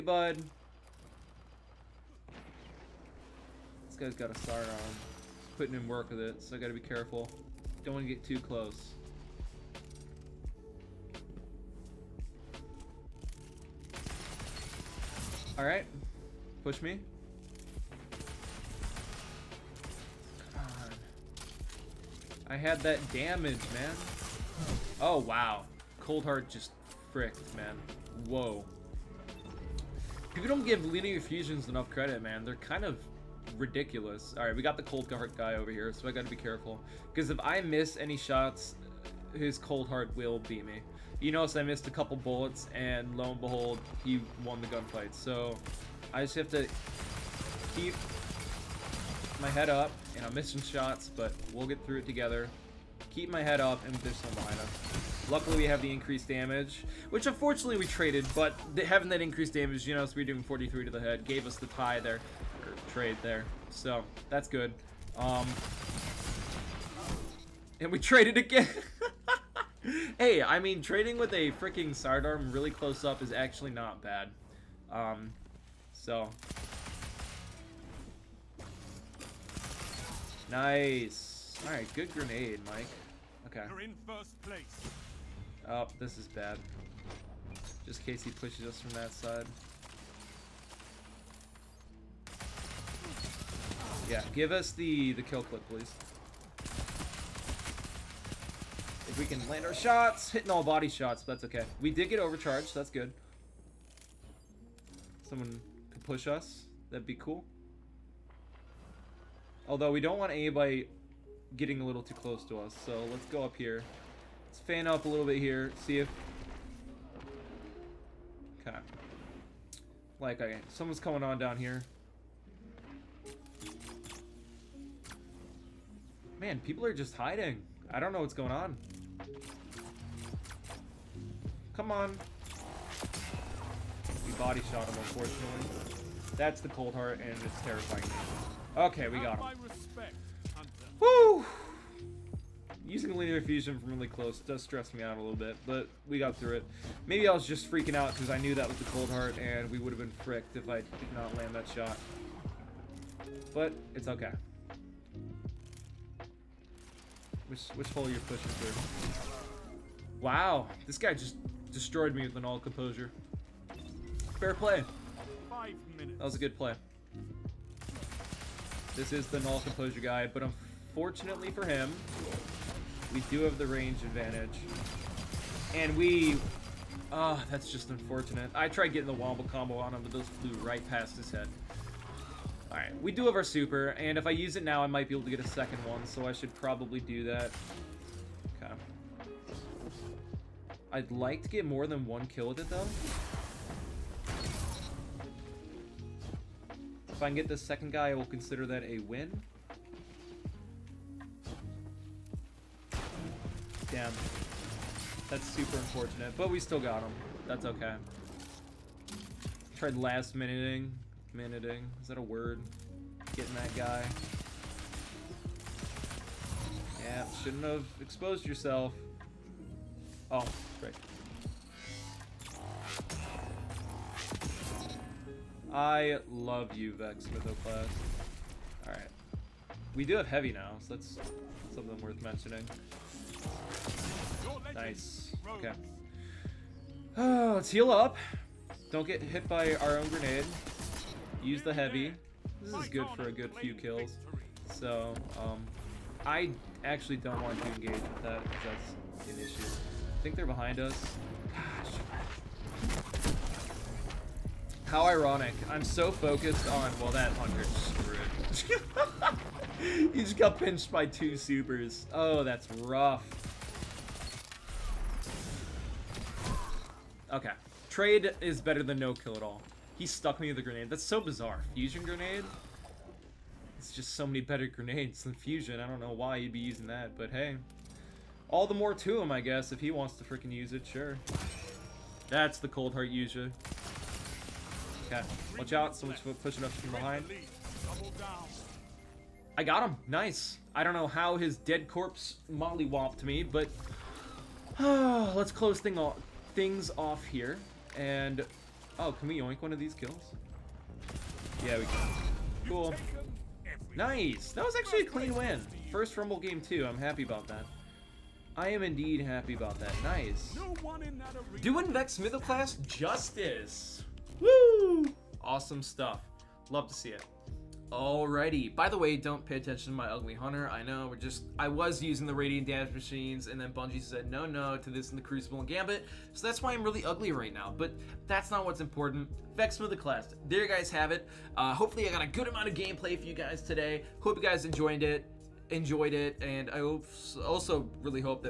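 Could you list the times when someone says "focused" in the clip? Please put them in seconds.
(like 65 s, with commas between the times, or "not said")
256 s.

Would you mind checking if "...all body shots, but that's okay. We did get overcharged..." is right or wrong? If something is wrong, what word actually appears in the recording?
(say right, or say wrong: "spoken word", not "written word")
right.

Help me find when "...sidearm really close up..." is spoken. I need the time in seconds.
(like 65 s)
71 s.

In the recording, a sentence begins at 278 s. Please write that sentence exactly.
All the more to him, I guess, if he wants to freaking use it, sure.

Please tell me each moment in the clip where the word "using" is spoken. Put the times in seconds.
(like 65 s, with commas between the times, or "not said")
142 s, 276 s, 322 s.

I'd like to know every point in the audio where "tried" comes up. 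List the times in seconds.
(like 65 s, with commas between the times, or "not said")
178 s, 209 s.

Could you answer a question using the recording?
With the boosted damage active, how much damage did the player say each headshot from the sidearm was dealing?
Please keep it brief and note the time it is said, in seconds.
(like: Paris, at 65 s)
43, at 60 s.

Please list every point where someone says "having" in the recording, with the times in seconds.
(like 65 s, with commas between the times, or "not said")
58 s.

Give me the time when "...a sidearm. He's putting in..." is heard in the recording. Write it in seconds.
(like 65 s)
4 s.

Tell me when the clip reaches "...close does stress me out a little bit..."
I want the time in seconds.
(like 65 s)
144 s.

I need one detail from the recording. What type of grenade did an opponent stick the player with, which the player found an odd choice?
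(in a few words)
Fusion grenade.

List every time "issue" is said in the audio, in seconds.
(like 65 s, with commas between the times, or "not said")
249 s.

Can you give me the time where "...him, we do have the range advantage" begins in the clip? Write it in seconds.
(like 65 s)
171 s.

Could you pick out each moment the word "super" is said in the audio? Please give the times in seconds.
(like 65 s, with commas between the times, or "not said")
183 s, 205 s, 261 s.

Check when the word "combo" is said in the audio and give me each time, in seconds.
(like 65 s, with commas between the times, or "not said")
179 s.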